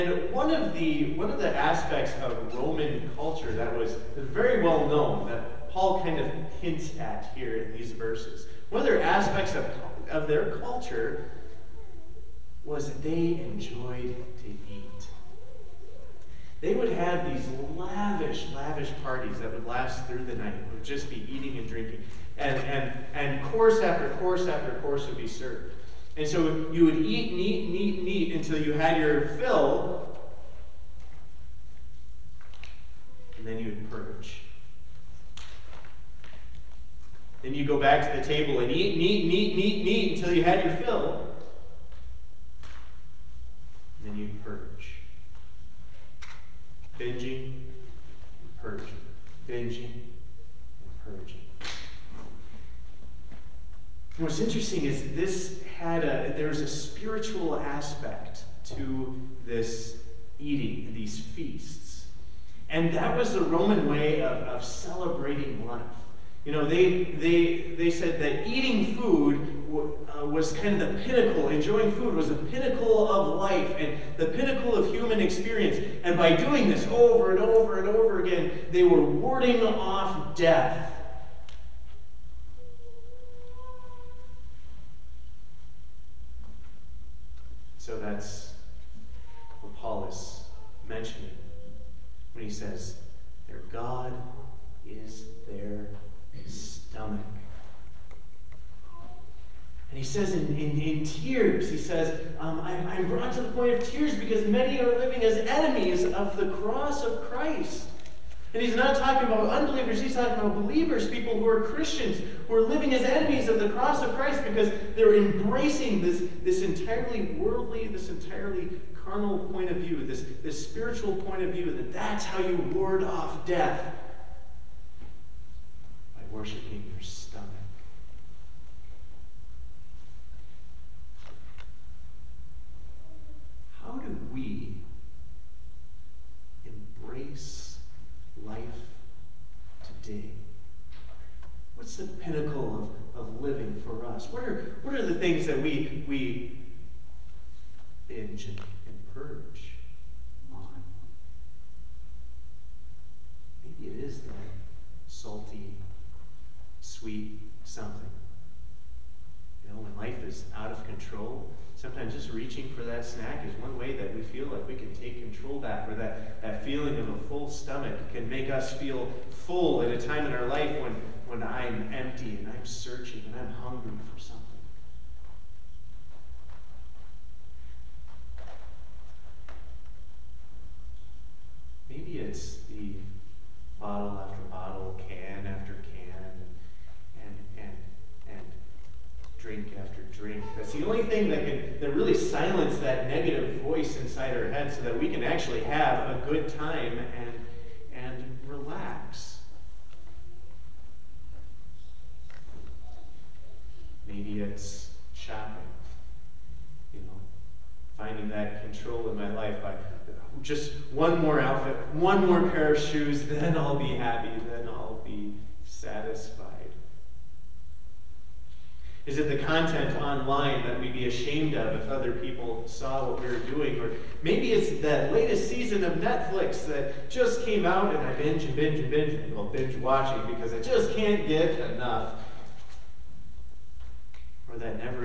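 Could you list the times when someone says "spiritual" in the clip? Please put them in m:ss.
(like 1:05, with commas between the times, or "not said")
0:56, 2:00.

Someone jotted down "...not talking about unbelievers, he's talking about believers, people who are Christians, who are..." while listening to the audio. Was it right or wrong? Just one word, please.
right.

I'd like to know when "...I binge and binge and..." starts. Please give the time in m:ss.
3:48.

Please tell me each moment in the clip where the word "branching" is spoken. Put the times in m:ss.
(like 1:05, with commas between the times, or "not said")
not said.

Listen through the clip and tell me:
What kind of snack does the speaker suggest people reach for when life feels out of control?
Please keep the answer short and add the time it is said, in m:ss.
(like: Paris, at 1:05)
Salty, sweet something, at 2:35.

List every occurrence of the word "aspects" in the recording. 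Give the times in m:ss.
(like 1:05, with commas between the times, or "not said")
0:01, 0:09, 0:57.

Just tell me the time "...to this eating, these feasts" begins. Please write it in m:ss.
0:58.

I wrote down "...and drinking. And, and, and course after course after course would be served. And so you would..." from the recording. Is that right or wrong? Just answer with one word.
right.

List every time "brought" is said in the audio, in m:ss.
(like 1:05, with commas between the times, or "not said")
1:43.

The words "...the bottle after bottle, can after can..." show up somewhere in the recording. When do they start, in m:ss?
3:02.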